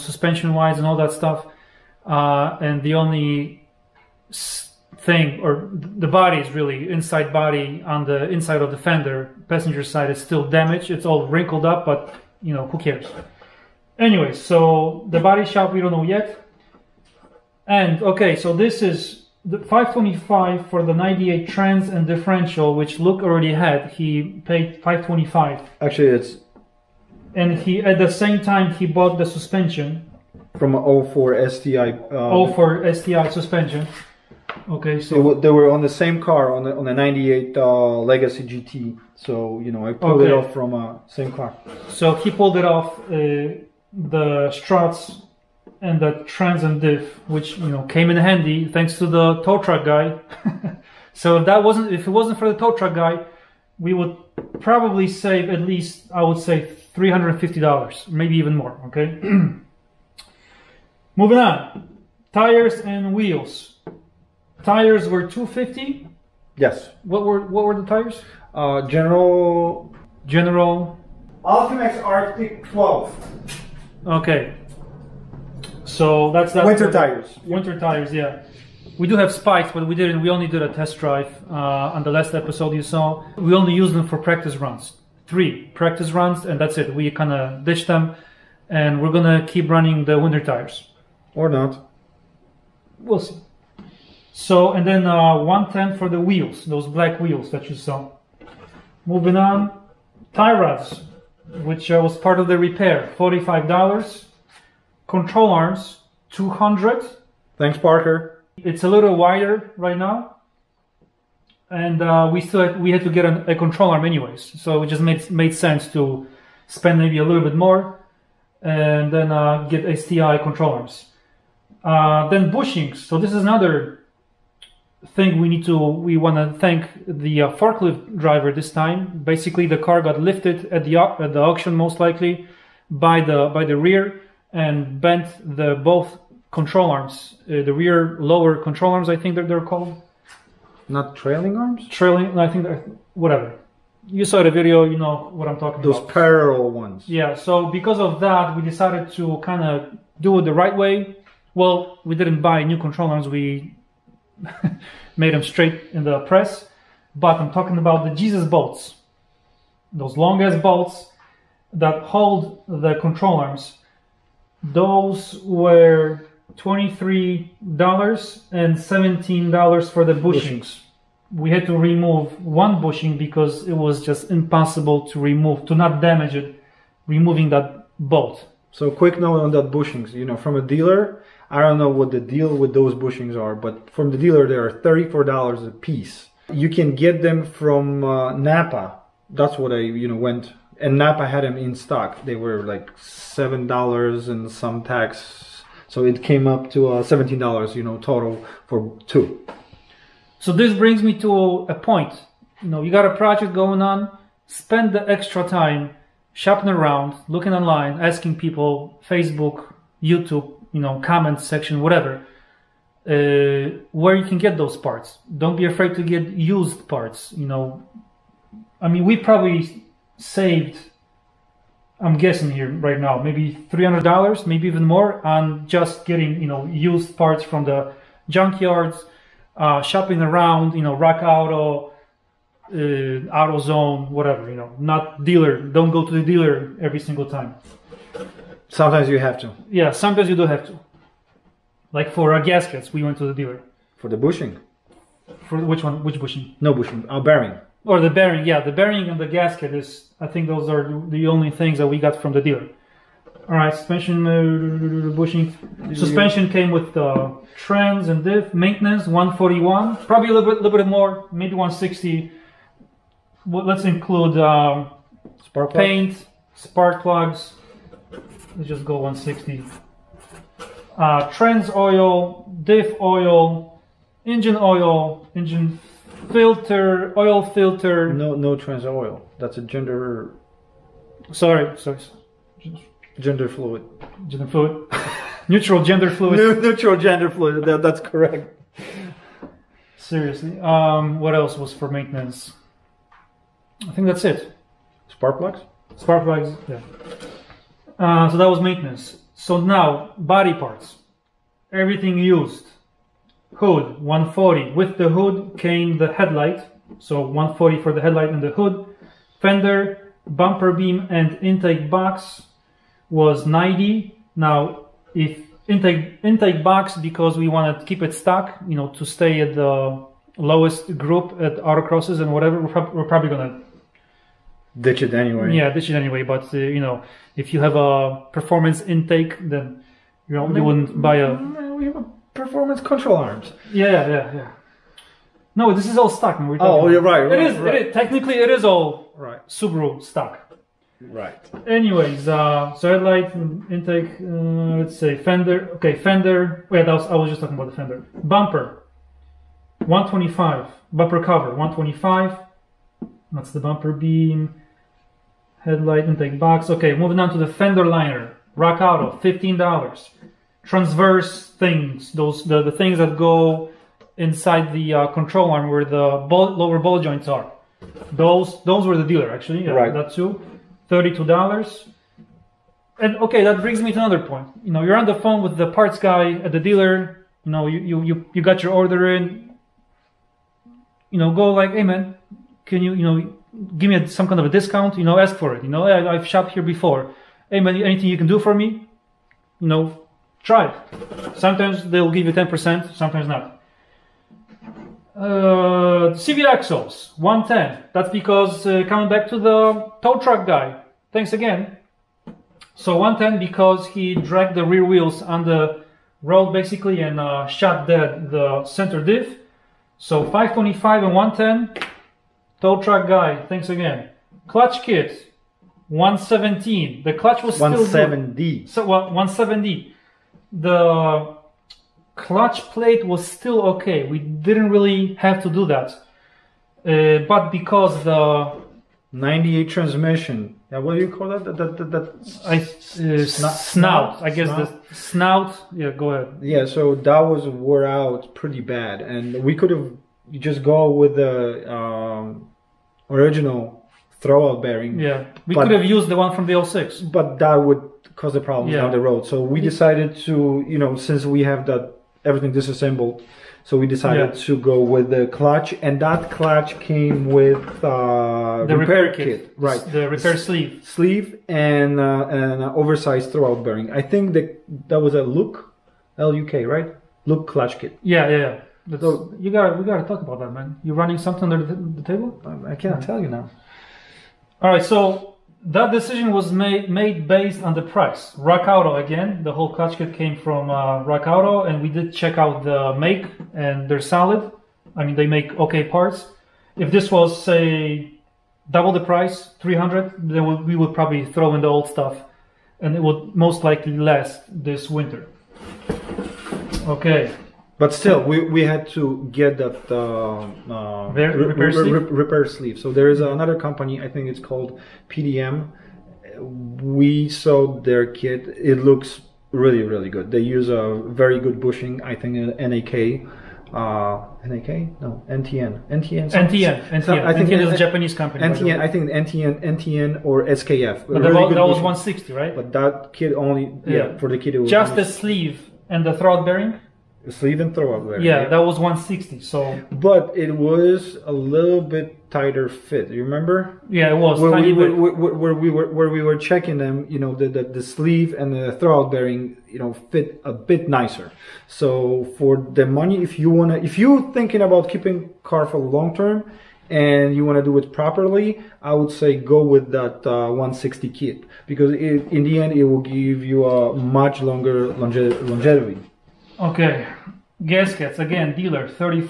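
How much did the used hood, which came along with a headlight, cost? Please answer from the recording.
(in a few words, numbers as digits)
$140.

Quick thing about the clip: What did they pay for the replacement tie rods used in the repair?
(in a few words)
$45.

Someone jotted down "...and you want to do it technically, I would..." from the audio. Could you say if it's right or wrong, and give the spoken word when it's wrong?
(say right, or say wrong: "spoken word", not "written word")
wrong: "properly", not "technically".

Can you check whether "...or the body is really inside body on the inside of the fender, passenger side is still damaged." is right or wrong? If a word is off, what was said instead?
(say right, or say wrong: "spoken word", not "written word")
right.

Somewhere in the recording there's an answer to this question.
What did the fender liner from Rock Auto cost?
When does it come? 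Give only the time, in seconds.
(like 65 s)
359 s.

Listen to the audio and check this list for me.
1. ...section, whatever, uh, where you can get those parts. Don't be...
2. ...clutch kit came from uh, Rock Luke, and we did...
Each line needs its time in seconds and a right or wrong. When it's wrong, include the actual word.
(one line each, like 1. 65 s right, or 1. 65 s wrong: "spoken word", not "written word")
1. 211 s right
2. 479 s wrong: "Auto", not "Luke".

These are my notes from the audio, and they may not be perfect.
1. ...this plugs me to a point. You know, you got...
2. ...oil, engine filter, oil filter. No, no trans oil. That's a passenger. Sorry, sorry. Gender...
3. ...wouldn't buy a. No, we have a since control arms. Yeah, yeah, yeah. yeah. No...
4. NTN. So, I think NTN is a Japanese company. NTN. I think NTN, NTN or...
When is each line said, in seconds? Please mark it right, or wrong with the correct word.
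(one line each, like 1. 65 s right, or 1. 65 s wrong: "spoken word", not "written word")
1. 200 s wrong: "brings", not "plugs"
2. 274 s wrong: "gender", not "passenger"
3. 330 s wrong: "performance", not "since"
4. 516 s right.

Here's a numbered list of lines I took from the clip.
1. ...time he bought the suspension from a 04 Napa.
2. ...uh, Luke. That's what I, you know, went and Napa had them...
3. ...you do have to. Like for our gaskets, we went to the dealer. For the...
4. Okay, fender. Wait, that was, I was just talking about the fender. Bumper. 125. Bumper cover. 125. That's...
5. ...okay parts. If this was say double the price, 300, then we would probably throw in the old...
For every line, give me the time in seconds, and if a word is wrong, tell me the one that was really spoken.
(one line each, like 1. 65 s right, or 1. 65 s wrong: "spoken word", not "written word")
1. 28 s wrong: "STI", not "Napa"
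2. 188 s wrong: "Napa", not "Luke"
3. 240 s right
4. 345 s right
5. 485 s right.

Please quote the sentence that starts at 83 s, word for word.
We only used them for practice runs.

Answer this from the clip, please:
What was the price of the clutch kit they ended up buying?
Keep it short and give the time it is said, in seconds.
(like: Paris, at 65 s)
$170, at 418 s.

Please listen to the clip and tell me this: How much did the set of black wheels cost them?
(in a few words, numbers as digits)
$110.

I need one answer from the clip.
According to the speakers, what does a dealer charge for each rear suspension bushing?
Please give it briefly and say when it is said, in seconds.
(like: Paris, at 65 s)
$34, at 184 s.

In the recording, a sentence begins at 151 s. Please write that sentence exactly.
Well, we didn't buy new control arms.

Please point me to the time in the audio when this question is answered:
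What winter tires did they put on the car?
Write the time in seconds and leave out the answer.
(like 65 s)
71 s.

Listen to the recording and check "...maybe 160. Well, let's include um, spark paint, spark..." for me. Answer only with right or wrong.
right.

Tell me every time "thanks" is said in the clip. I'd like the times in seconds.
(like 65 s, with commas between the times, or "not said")
48 s, 107 s, 126 s, 401 s, 413 s.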